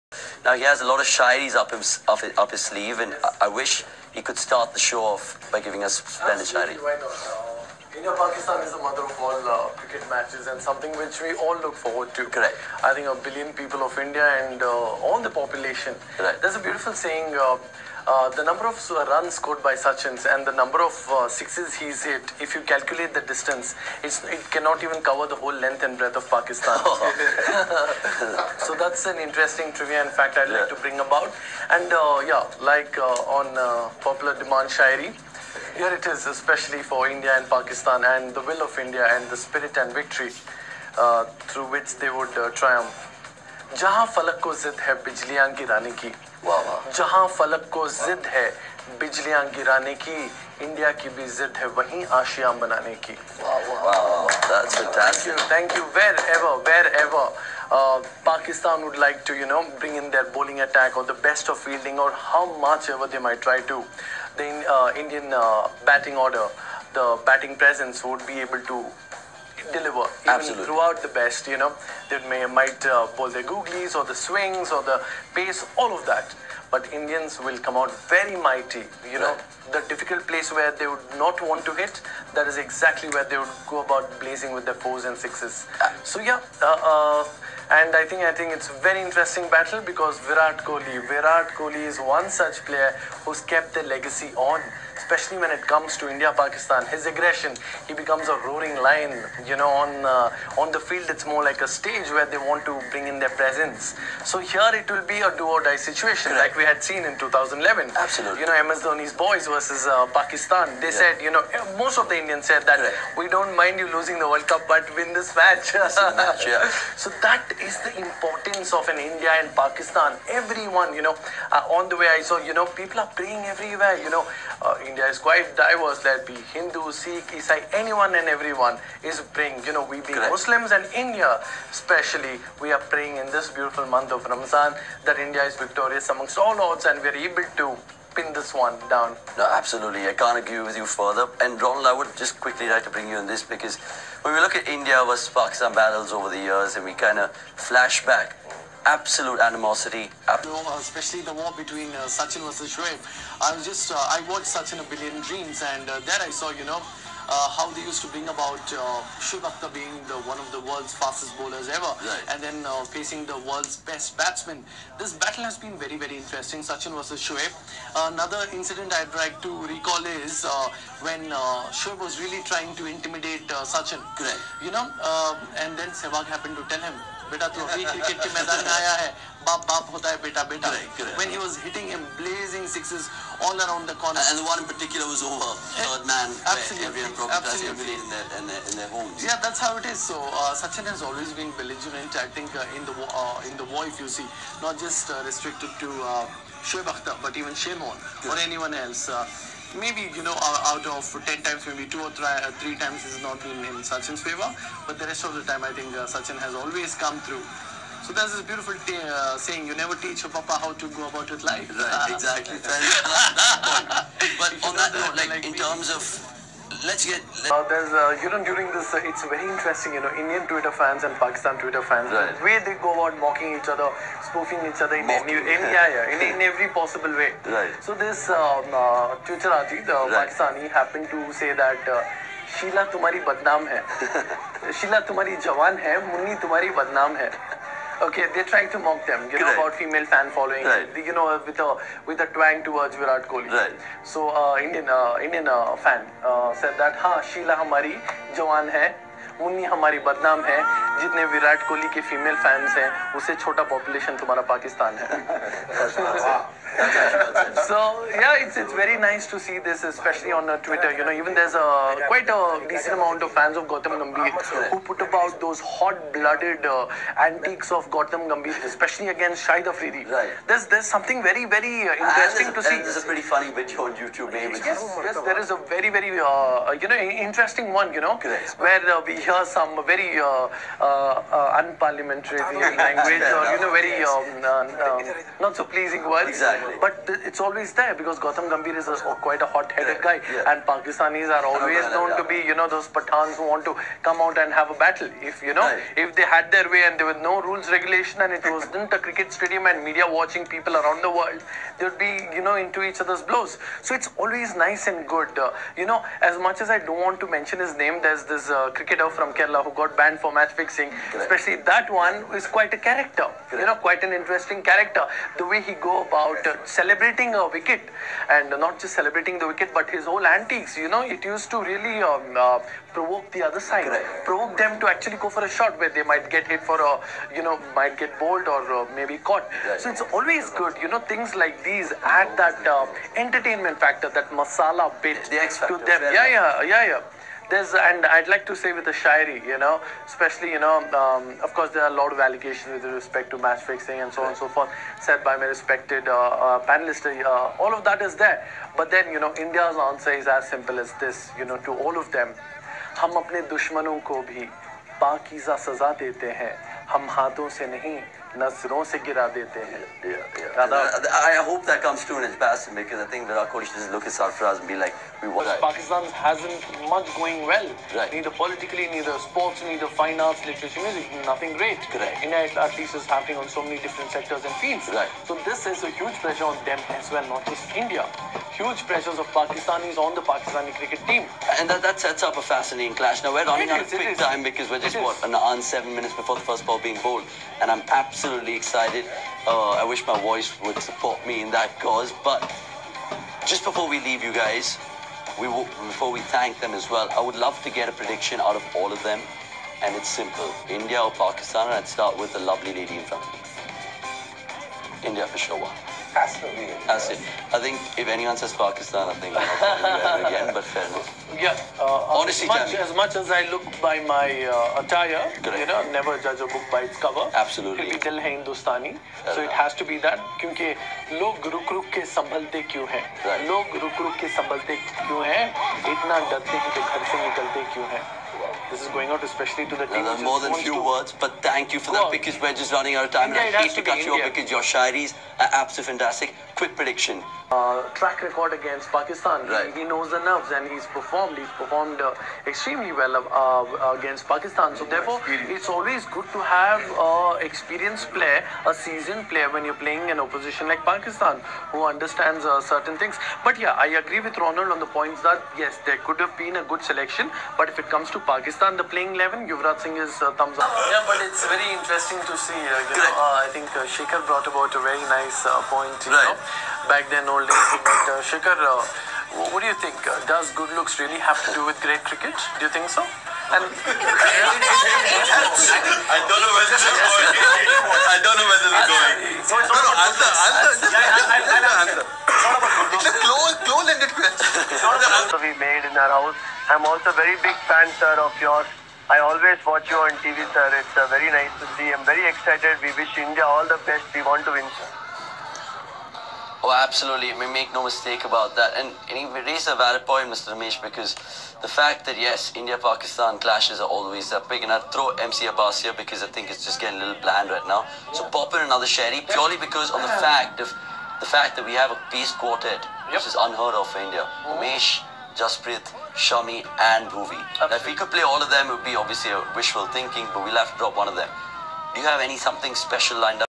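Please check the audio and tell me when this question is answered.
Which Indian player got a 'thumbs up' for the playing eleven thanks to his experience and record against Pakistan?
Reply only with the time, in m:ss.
7:39.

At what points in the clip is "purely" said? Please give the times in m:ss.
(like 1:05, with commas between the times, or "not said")
8:29.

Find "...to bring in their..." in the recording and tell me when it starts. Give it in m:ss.
1:42.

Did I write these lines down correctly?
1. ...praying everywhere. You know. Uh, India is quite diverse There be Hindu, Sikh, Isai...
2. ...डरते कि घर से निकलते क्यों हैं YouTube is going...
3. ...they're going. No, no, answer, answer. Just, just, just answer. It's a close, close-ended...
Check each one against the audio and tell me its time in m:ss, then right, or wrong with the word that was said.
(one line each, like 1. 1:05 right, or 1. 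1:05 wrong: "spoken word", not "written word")
1. 2:03 right
2. 7:06 wrong: "This", not "YouTube"
3. 7:58 right.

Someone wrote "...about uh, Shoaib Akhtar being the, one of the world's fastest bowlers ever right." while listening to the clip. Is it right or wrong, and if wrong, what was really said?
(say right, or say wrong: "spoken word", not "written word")
right.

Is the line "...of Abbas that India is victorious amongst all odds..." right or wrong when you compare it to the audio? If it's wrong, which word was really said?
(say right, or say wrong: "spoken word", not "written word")
wrong: "Ramzan", not "Abbas".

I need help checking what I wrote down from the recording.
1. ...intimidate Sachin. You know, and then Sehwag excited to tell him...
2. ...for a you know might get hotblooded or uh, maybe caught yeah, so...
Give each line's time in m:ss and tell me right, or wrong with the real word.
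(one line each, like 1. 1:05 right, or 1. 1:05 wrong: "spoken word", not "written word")
1. 2:52 wrong: "happened", not "excited"
2. 5:26 wrong: "bowled", not "hotblooded".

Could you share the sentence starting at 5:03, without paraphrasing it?
So it's always nice and good.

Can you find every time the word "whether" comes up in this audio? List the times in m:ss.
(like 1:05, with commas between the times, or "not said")
7:53, 7:58.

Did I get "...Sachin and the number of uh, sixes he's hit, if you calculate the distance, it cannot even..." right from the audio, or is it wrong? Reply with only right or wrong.
right.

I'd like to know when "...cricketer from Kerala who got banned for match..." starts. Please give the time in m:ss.
5:08.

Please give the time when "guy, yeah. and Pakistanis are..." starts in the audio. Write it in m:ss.
4:50.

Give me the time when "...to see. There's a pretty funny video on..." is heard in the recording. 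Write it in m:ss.
4:32.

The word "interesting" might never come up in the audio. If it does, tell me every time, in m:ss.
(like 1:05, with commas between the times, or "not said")
0:29, 1:29, 2:46, 3:39, 4:31, 4:36, 5:14, 7:41.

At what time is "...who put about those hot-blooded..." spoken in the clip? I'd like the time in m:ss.
4:24.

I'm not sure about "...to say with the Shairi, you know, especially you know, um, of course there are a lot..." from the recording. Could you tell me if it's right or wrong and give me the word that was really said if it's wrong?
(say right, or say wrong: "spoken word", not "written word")
right.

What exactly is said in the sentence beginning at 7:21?
He's performed uh, extremely well uh, uh against Pakistan.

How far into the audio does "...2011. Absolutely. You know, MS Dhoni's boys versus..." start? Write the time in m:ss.
1:47.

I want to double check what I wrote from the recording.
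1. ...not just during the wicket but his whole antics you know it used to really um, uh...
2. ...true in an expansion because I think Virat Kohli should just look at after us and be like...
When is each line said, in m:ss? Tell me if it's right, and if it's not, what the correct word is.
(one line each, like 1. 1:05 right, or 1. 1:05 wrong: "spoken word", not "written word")
1. 5:18 wrong: "celebrating", not "during"
2. 6:02 right.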